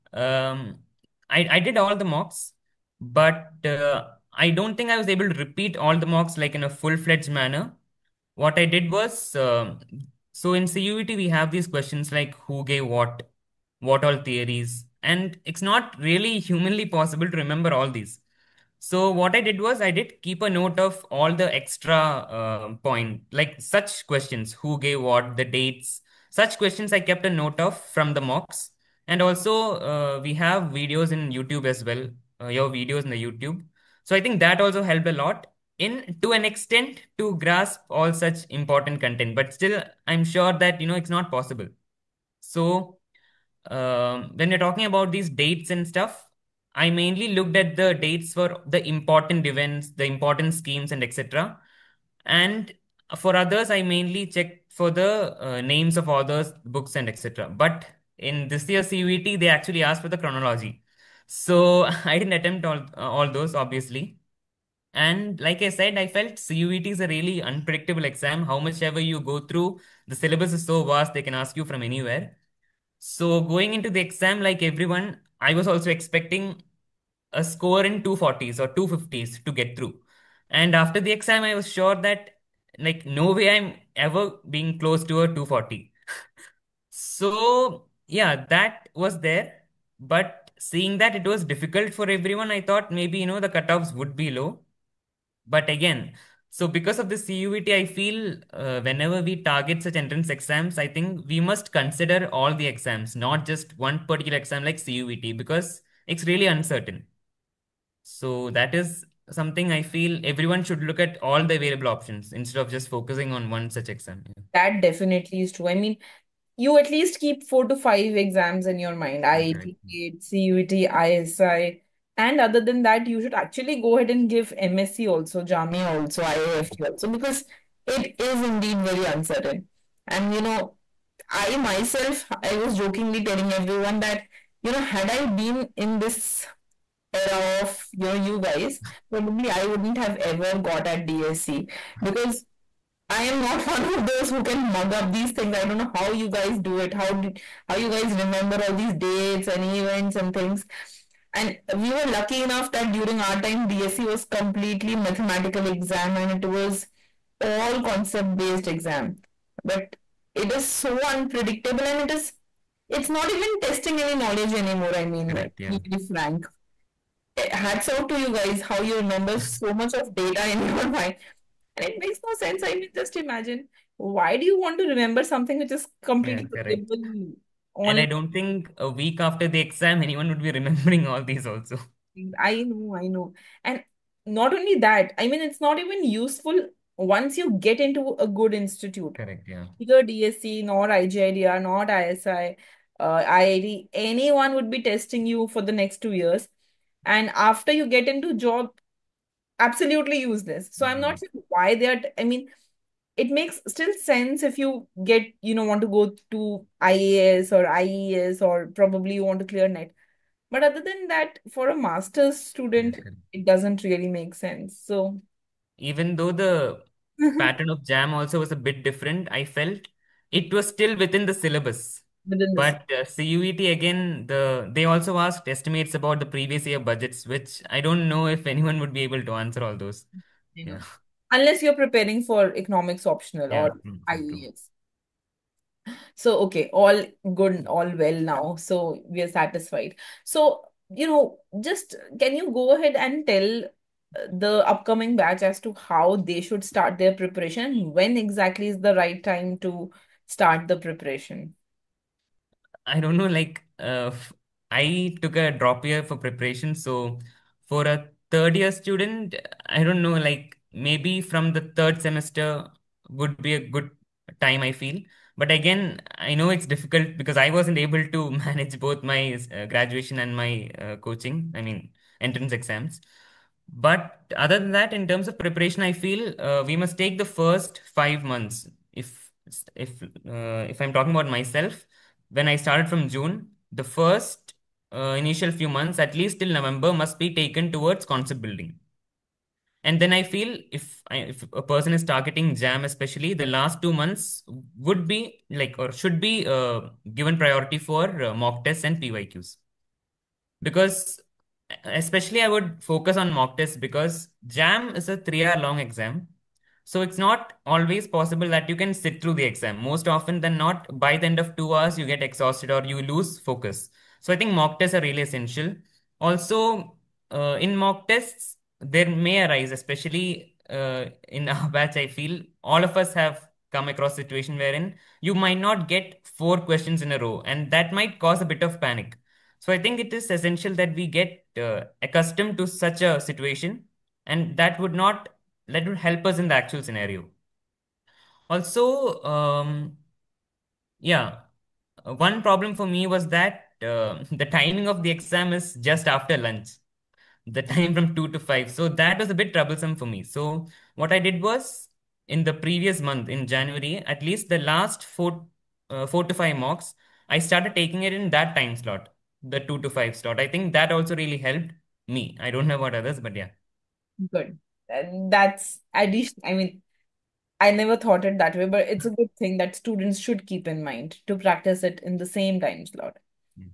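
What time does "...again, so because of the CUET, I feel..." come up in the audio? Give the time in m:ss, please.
1:35.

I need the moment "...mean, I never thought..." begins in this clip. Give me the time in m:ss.
6:06.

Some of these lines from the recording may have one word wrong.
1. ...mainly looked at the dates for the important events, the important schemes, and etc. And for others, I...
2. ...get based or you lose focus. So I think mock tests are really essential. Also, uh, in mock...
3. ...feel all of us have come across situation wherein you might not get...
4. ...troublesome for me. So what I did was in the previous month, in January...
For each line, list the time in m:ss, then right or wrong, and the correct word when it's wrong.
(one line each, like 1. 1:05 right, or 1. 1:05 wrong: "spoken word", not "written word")
1. 0:46 right
2. 5:12 wrong: "exhausted", not "based"
3. 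5:22 right
4. 5:49 right.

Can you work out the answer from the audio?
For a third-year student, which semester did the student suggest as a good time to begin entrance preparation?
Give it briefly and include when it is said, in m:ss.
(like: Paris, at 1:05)
Third semester, at 4:21.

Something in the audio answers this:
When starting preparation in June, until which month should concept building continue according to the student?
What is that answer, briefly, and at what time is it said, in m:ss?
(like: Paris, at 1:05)
November, at 4:46.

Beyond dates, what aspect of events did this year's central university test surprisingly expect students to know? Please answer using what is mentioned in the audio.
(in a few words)
Chronology.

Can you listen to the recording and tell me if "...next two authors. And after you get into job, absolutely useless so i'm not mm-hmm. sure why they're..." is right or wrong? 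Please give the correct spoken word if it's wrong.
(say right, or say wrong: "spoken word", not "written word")
wrong: "years", not "authors".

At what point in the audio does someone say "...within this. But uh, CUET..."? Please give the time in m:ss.
3:42.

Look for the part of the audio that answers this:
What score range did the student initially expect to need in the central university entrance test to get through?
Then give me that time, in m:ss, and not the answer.
1:18.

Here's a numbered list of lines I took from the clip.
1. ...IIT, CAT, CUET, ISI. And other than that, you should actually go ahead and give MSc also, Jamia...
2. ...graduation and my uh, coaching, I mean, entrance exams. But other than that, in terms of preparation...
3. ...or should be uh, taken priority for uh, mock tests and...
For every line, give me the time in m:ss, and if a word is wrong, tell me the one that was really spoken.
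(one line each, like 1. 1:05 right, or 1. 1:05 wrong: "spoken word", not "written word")
1. 1:59 right
2. 4:29 right
3. 4:55 wrong: "given", not "taken".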